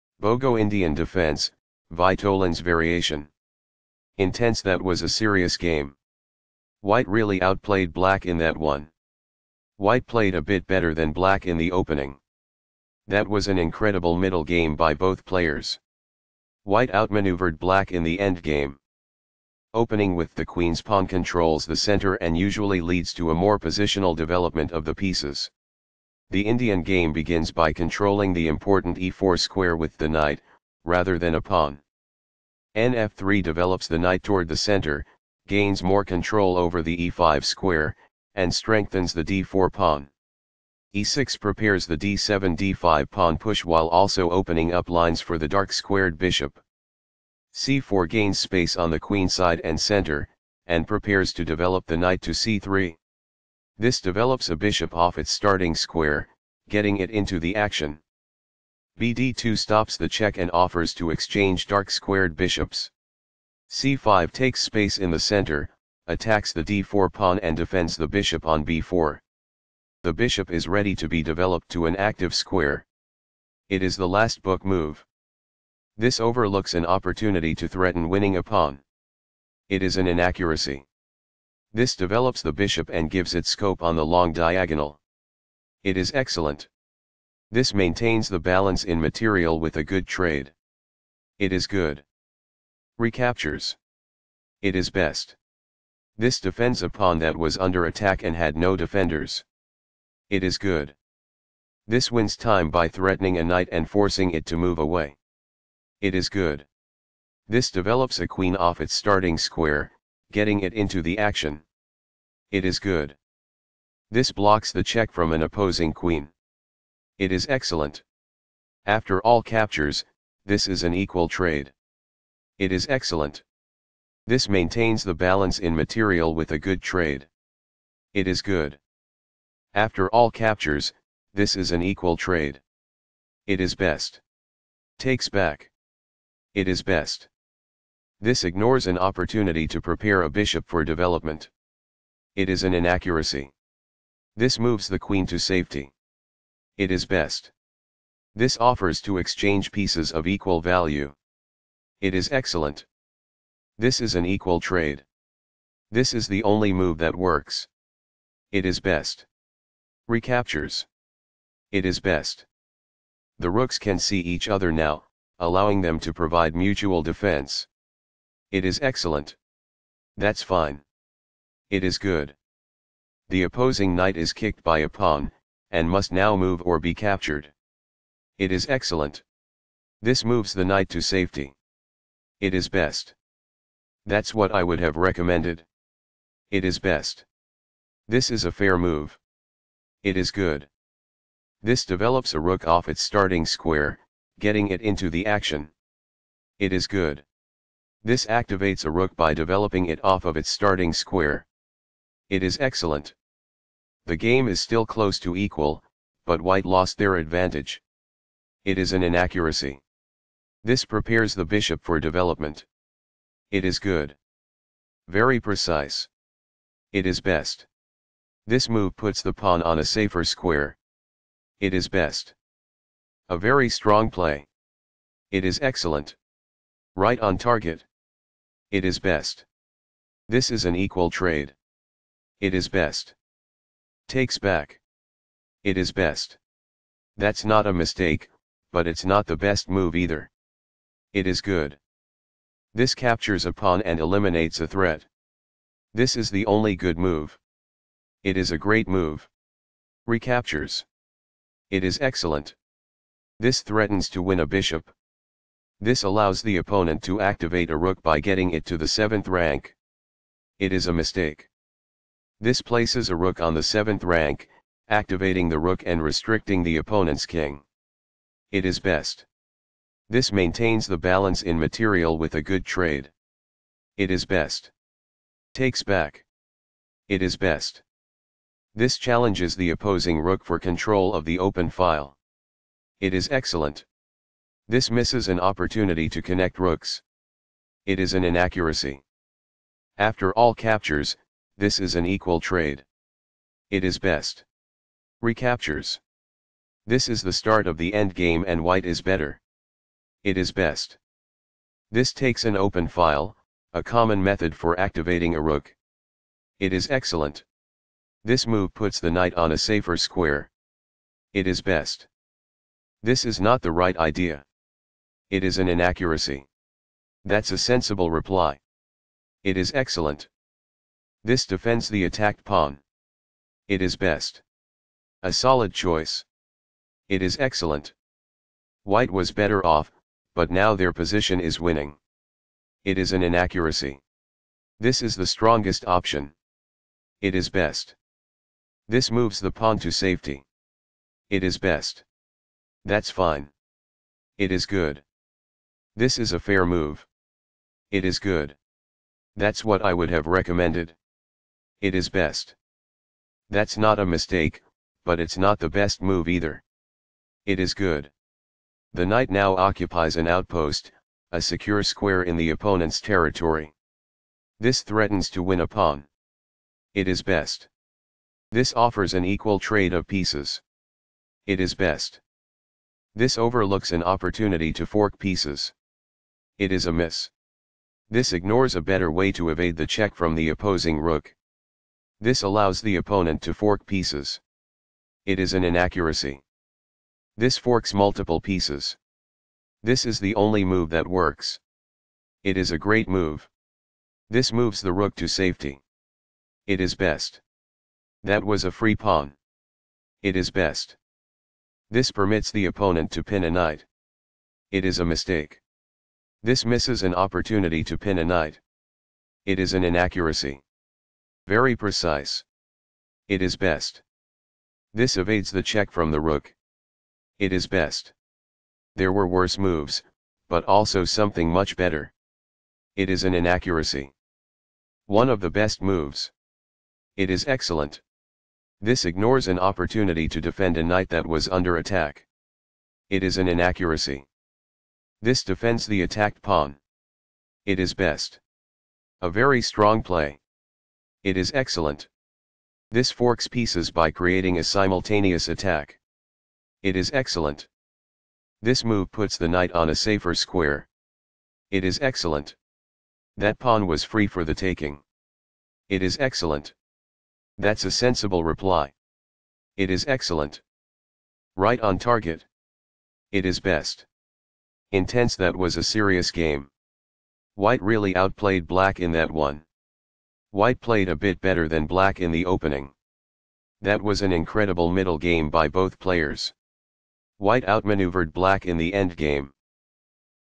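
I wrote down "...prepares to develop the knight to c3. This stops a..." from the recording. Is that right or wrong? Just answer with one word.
wrong.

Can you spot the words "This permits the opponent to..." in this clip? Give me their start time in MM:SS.
06:41.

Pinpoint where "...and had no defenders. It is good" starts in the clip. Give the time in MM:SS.
01:38.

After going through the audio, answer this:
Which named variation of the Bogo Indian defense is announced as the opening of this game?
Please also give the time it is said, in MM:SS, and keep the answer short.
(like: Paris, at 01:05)
Vitolin's variation, at 00:01.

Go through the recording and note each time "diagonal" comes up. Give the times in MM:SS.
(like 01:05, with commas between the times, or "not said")
01:24.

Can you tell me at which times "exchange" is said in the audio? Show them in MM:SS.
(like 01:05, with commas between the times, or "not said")
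01:01, 02:29.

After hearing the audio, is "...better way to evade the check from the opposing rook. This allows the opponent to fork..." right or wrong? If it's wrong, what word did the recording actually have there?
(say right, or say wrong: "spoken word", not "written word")
right.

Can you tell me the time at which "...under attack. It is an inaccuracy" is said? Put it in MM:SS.
07:11.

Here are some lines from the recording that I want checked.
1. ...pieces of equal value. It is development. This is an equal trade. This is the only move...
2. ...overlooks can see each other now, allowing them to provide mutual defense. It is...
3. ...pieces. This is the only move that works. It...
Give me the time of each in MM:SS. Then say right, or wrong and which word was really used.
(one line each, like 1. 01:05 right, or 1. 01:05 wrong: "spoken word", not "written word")
1. 02:29 wrong: "excellent", not "development"
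2. 02:43 wrong: "rooks", not "overlooks"
3. 06:28 right.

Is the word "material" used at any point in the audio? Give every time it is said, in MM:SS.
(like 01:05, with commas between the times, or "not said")
01:28, 02:05, 04:31.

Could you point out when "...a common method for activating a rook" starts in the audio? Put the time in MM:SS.
05:03.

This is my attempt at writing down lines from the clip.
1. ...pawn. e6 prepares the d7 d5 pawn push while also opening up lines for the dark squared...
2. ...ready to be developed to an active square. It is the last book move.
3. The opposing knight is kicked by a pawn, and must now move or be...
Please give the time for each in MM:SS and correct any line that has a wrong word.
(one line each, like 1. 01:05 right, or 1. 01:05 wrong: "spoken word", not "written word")
1. 00:39 right
2. 01:10 right
3. 02:53 right.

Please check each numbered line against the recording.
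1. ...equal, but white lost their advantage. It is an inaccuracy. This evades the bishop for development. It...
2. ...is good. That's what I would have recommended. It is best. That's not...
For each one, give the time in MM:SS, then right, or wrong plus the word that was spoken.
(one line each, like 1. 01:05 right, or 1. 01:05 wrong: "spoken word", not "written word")
1. 03:25 wrong: "prepares", not "evades"
2. 05:48 right.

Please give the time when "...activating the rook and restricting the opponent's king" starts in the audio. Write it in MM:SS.
04:24.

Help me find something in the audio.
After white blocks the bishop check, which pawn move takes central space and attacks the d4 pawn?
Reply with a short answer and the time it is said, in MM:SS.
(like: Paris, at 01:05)
C5, at 01:03.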